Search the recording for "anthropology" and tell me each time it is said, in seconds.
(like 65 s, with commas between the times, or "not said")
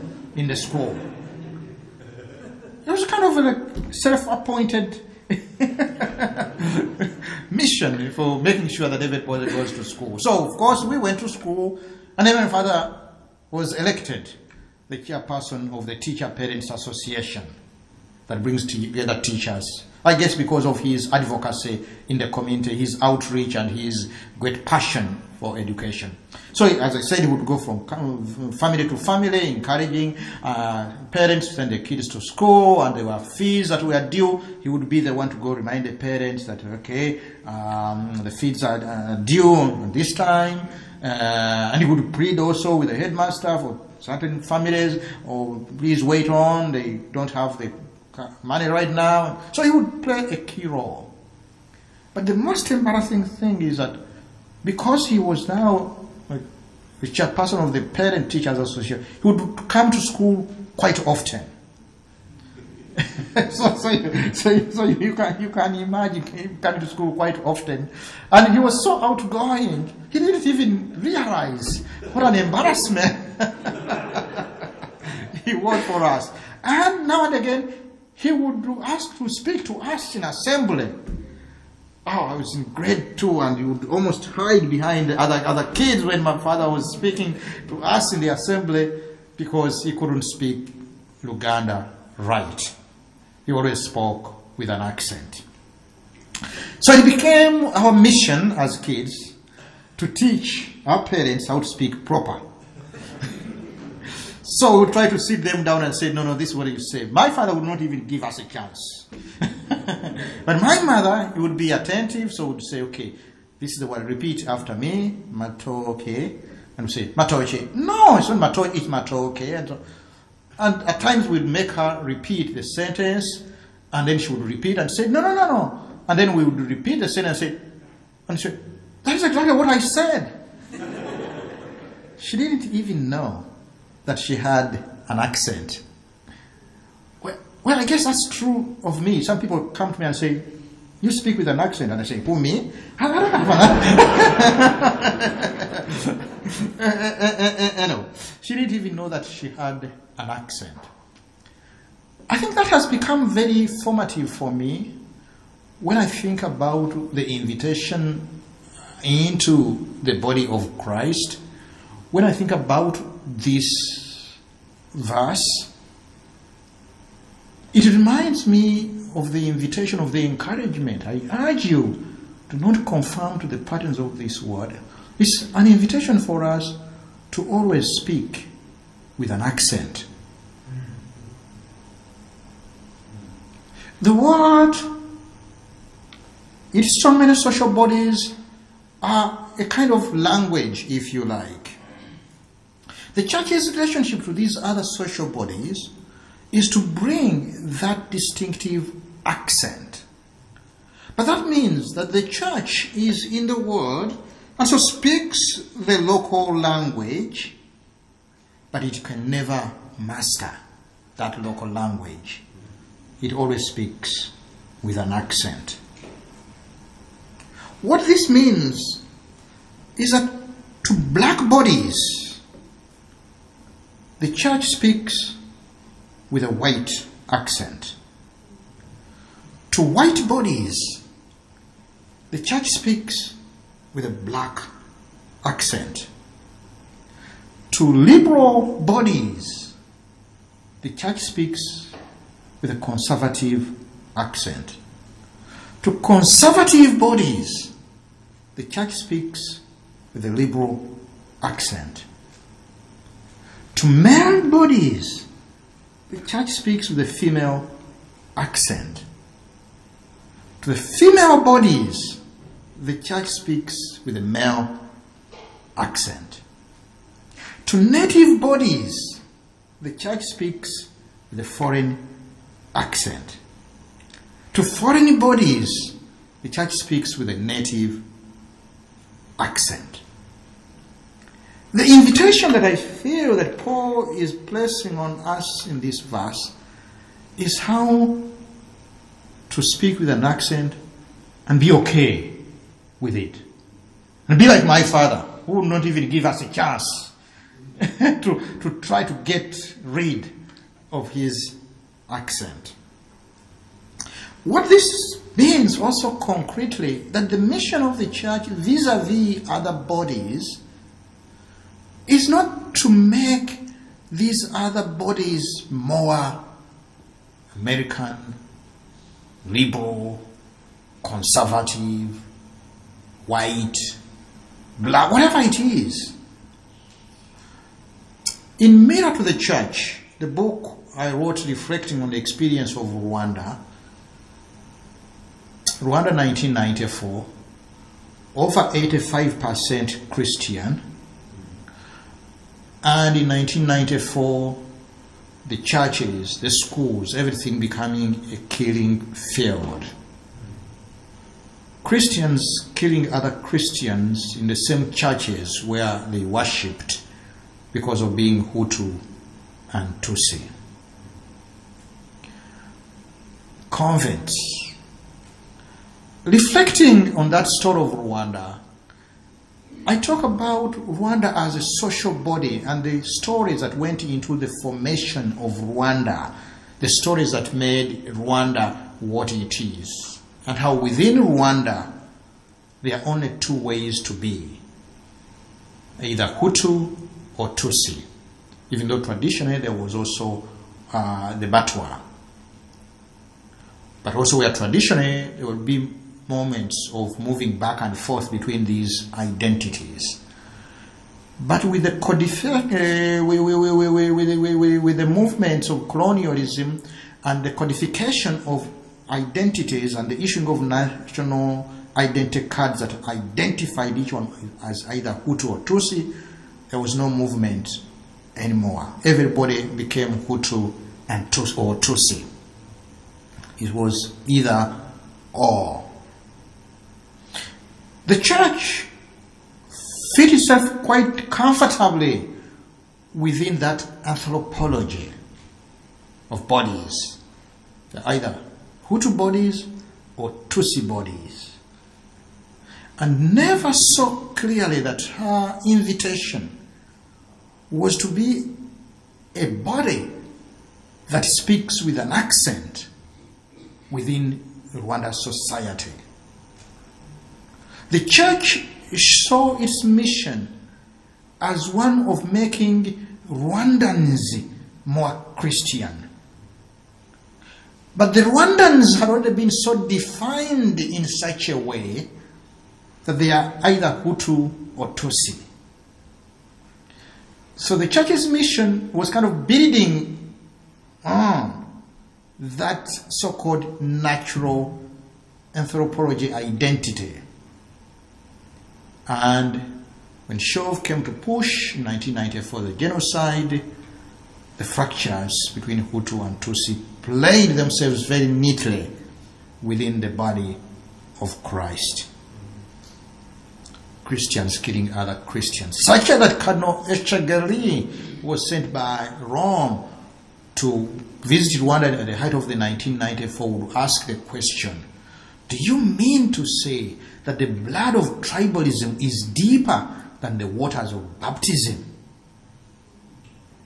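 434 s, 485 s.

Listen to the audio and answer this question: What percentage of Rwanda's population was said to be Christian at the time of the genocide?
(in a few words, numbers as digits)
Over 85%.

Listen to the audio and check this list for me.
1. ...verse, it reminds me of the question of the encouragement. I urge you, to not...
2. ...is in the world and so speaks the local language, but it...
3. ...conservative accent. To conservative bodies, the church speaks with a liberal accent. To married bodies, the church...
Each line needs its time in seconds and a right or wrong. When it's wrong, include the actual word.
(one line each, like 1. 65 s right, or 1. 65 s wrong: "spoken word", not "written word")
1. 164 s wrong: "invitation", not "question"
2. 202 s right
3. 242 s right.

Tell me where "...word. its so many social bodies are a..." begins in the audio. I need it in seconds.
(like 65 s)
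184 s.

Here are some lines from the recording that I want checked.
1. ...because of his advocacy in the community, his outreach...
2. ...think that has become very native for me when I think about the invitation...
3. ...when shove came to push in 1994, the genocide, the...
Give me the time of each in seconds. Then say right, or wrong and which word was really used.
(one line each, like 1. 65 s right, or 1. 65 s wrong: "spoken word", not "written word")
1. 20 s right
2. 152 s wrong: "formative", not "native"
3. 490 s right.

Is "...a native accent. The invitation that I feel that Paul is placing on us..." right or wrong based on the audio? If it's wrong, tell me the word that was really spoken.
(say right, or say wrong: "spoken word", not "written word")
right.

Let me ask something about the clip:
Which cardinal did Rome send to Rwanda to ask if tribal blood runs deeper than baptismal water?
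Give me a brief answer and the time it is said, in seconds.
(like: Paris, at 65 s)
Cardinal Etchegaray, at 506 s.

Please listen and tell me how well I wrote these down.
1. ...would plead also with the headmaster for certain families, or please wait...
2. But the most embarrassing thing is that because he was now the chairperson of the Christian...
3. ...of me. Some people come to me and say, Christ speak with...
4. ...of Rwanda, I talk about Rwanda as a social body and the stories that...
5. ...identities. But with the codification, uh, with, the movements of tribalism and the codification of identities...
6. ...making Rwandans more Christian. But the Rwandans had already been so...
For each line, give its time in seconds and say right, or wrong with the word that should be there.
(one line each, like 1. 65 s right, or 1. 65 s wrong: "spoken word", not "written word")
1. 41 s right
2. 52 s wrong: "Parent", not "Christian"
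3. 138 s wrong: "You", not "Christ"
4. 367 s right
5. 399 s wrong: "colonialism", not "tribalism"
6. 462 s right.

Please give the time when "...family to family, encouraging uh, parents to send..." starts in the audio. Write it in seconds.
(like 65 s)
28 s.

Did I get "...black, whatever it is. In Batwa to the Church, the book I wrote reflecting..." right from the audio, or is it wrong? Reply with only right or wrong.
wrong.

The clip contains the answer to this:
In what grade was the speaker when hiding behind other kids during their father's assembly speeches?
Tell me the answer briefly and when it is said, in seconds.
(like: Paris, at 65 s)
Grade two, at 82 s.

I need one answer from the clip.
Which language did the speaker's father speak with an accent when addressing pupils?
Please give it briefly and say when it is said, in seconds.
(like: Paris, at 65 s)
Luganda, at 91 s.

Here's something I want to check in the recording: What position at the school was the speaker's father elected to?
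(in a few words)
Chairperson of the Parent Teachers Association.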